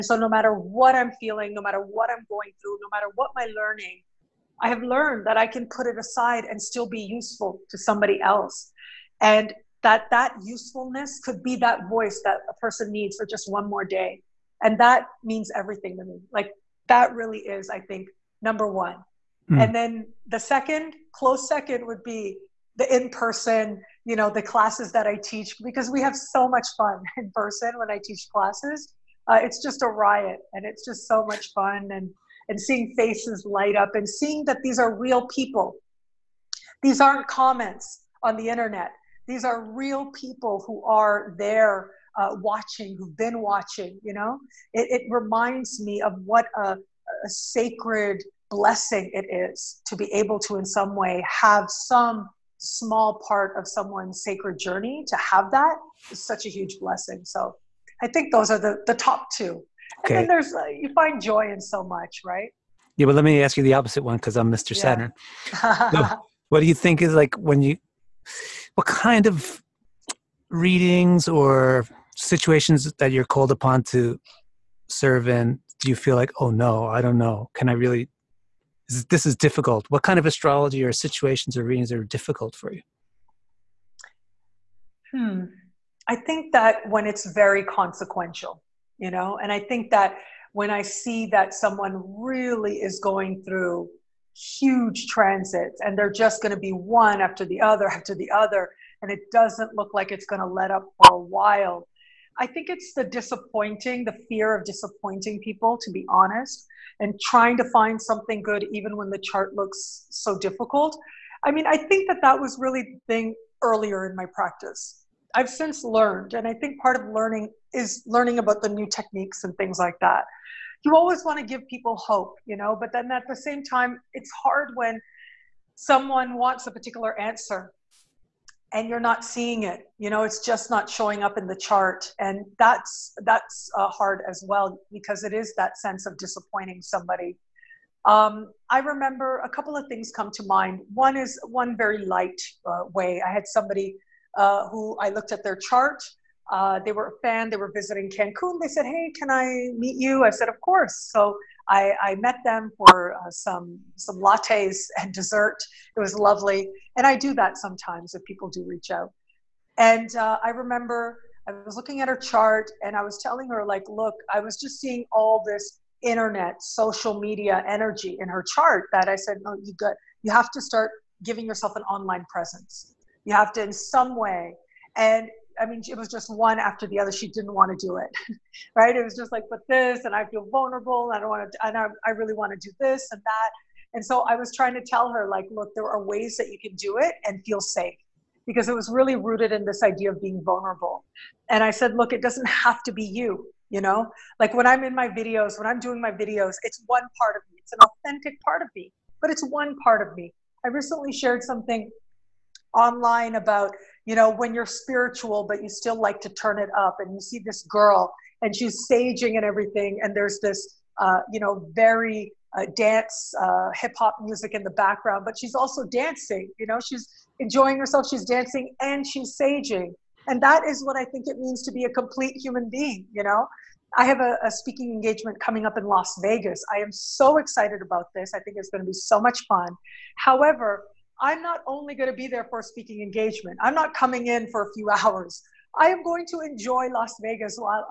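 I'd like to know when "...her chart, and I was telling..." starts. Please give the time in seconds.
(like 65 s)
162 s.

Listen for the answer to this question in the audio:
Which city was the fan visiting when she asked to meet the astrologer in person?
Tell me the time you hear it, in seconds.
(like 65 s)
148 s.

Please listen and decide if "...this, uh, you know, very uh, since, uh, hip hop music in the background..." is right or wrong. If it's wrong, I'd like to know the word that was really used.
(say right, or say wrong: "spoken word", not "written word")
wrong: "dance", not "since".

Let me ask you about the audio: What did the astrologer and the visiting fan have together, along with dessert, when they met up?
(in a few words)
Lattes.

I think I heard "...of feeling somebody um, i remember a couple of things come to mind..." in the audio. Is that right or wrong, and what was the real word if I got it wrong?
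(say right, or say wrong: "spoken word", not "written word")
wrong: "disappointing", not "feeling".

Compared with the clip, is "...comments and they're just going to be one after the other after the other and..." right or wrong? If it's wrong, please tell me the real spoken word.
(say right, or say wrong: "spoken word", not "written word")
wrong: "transits", not "comments".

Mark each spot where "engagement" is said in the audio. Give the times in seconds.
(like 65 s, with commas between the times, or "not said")
224 s, 233 s.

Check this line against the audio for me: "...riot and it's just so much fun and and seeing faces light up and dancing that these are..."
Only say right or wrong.
wrong.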